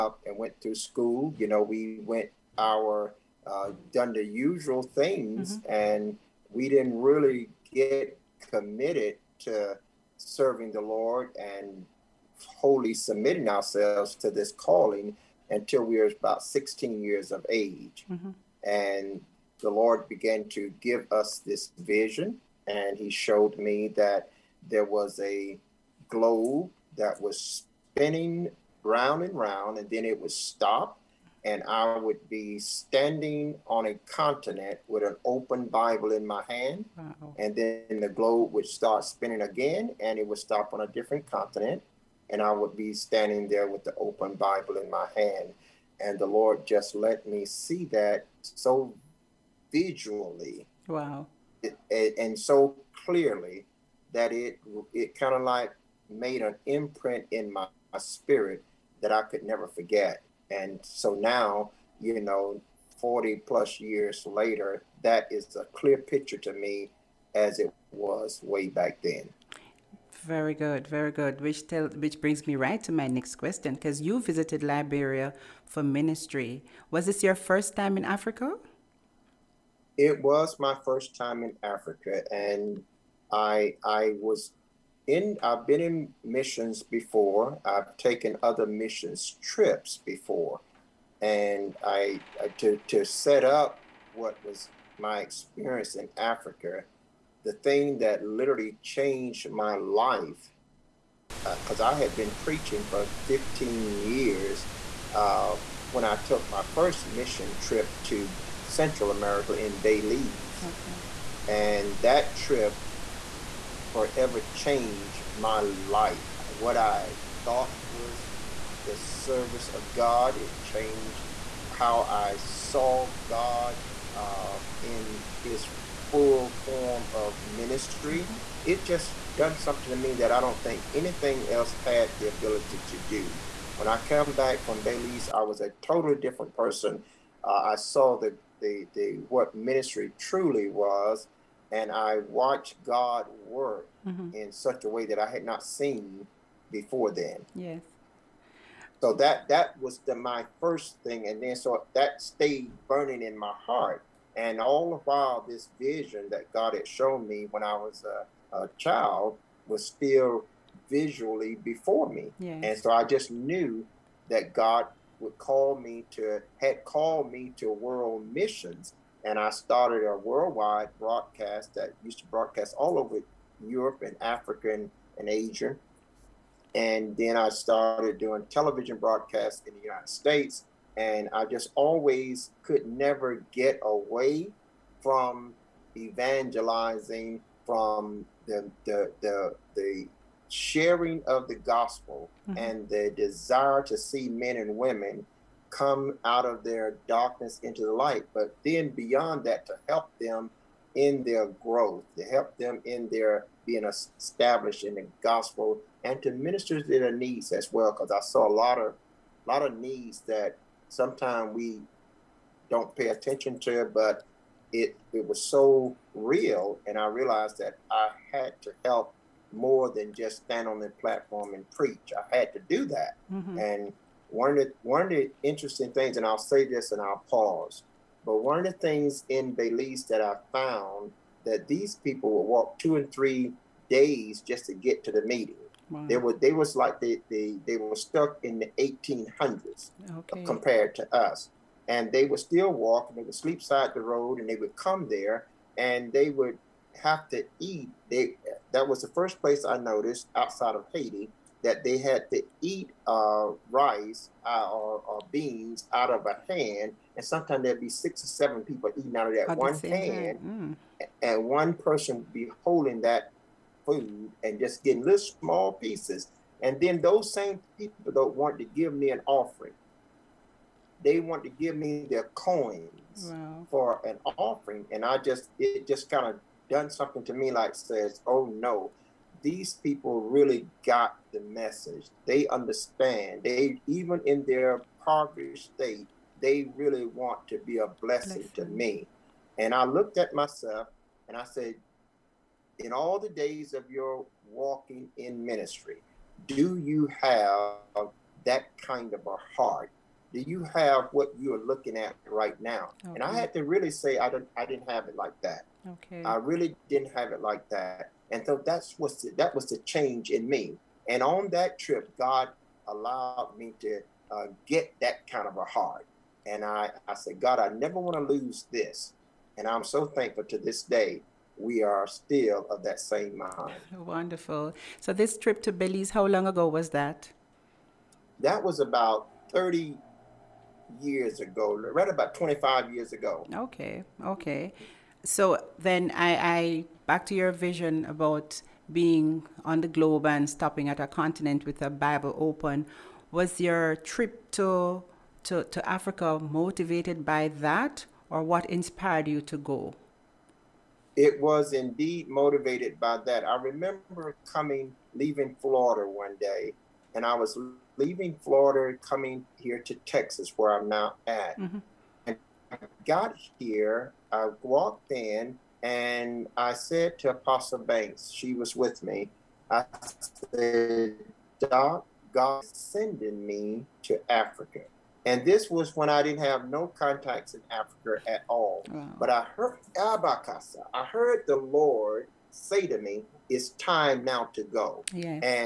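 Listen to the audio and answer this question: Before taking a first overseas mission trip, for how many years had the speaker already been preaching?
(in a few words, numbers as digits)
15 years.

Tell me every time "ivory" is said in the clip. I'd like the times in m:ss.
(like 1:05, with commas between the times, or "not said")
not said.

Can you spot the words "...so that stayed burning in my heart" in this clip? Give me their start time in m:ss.
2:31.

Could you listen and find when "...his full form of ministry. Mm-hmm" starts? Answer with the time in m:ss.
2:05.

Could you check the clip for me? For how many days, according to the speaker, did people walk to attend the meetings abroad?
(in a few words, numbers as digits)
2 and 3 days.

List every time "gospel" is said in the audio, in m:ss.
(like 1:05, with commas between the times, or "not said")
3:11, 3:25.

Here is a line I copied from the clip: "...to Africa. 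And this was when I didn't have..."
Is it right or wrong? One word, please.
right.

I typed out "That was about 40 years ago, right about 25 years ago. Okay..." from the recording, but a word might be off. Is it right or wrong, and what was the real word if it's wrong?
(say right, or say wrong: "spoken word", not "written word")
wrong: "30", not "40".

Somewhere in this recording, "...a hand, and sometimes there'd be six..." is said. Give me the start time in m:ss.
4:16.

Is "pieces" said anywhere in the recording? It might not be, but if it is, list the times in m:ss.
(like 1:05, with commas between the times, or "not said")
4:25.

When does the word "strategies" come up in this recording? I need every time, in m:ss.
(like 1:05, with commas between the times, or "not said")
not said.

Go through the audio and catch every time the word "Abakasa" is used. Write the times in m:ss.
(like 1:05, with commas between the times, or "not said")
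6:19.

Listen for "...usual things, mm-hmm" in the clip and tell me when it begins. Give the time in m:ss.
0:04.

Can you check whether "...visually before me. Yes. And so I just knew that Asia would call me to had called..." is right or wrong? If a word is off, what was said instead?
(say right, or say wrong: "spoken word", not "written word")
wrong: "God", not "Asia".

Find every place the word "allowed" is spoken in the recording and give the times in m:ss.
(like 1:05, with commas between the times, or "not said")
5:12.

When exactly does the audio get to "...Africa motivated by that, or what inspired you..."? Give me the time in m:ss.
5:45.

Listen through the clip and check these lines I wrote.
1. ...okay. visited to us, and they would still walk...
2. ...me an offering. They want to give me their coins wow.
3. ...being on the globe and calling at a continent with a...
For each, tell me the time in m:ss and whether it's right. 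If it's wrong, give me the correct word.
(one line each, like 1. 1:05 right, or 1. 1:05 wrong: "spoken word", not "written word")
1. 4:00 wrong: "compared", not "visited"
2. 4:28 right
3. 5:38 wrong: "stopping", not "calling".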